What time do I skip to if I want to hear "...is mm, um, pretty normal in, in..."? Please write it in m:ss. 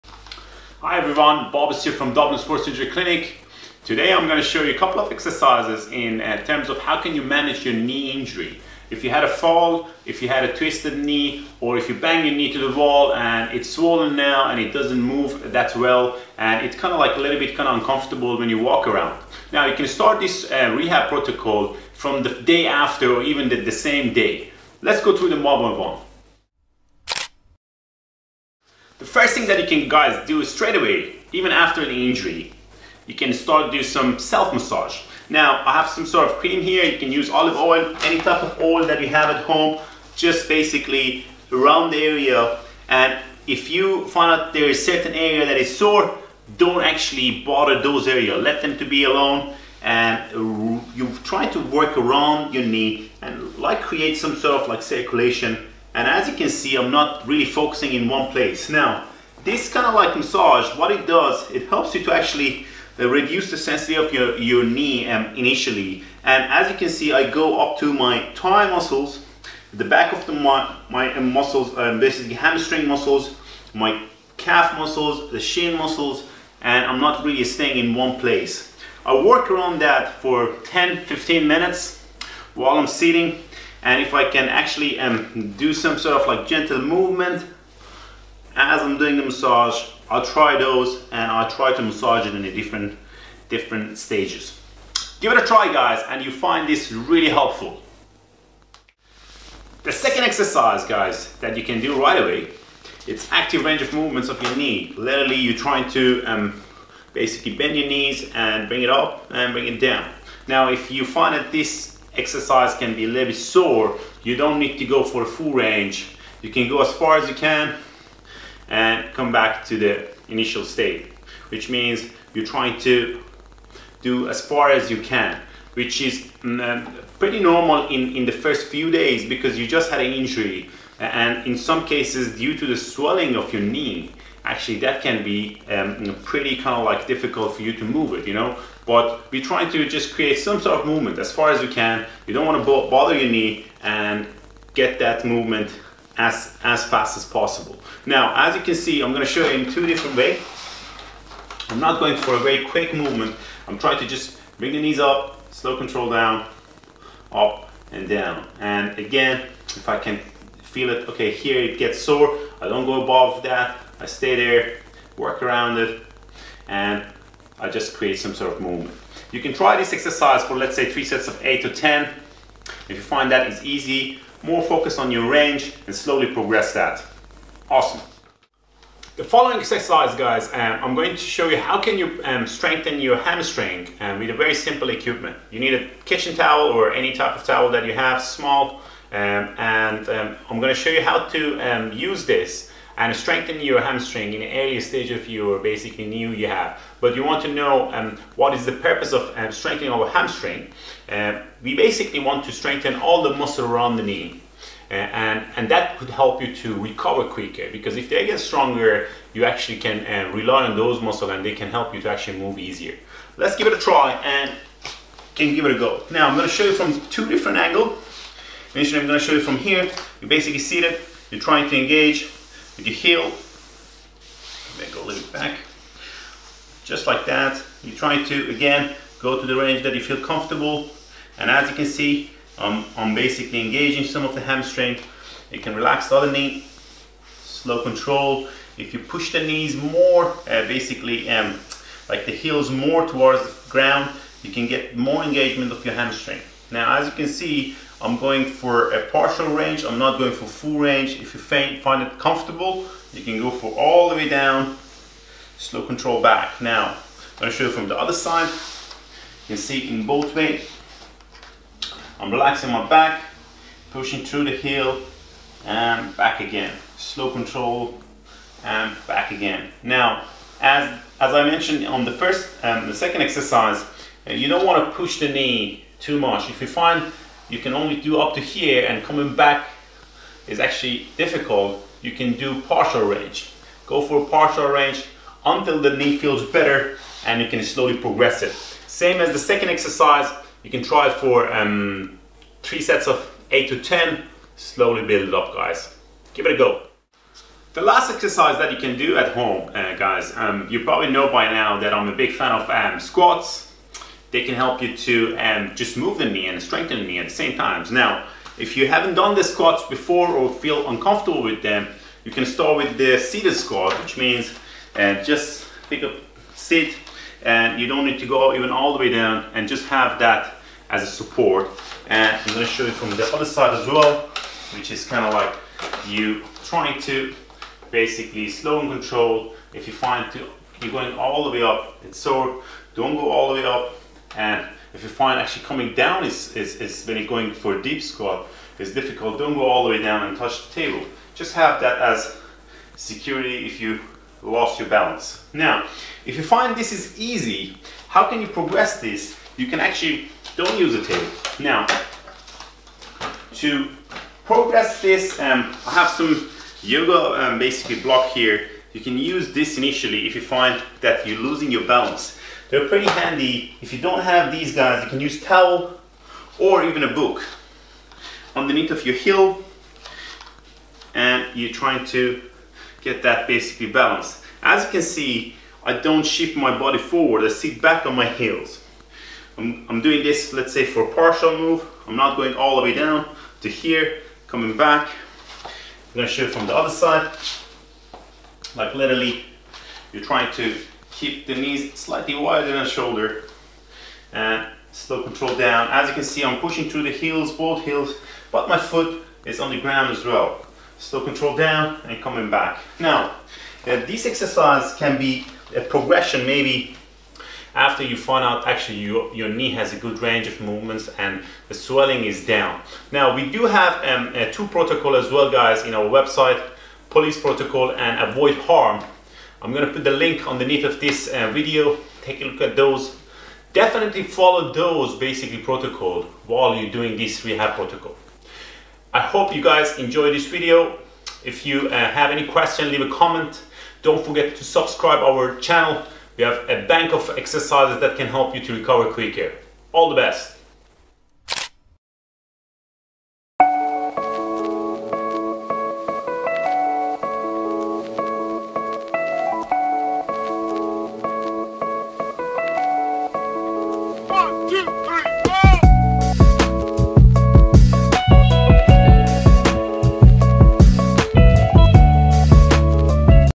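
2:06.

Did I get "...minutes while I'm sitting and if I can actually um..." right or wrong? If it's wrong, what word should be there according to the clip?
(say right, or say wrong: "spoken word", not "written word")
right.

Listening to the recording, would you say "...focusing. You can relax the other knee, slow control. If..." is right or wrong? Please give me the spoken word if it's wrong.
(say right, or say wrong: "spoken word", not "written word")
wrong: "hamstring", not "focusing".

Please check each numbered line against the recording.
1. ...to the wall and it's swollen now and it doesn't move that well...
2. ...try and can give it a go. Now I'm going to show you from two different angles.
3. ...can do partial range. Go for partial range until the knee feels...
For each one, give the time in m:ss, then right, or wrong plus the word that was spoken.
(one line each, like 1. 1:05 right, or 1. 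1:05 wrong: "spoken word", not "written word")
1. 0:12 right
2. 3:33 right
3. 4:42 right.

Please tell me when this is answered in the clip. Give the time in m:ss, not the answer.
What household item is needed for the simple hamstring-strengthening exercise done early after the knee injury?
3:06.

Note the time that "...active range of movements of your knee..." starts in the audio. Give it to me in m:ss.
1:43.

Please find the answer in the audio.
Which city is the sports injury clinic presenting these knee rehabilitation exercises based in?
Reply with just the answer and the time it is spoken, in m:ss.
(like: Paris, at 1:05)
Dublin, at 0:02.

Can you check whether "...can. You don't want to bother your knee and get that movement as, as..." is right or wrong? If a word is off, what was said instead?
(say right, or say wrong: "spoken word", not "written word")
right.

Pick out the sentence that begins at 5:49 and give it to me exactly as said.
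You can actually, don't use a table.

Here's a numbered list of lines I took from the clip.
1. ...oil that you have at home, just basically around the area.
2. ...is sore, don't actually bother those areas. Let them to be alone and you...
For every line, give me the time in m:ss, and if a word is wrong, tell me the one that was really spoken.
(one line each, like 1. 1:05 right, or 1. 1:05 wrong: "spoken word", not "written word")
1. 0:38 right
2. 0:45 right.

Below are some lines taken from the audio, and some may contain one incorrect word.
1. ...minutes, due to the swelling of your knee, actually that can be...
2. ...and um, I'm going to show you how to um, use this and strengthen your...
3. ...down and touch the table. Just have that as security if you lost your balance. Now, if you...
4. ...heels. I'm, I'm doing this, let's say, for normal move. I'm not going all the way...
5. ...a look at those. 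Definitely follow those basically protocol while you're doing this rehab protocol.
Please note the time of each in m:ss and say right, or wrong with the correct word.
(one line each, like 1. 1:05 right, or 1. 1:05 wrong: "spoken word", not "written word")
1. 2:11 wrong: "cases", not "minutes"
2. 3:09 right
3. 5:40 right
4. 6:18 wrong: "partial", not "normal"
5. 7:02 right.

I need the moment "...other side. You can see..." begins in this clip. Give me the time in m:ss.
4:17.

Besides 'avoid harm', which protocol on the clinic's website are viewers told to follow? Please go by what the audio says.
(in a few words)
Police protocol.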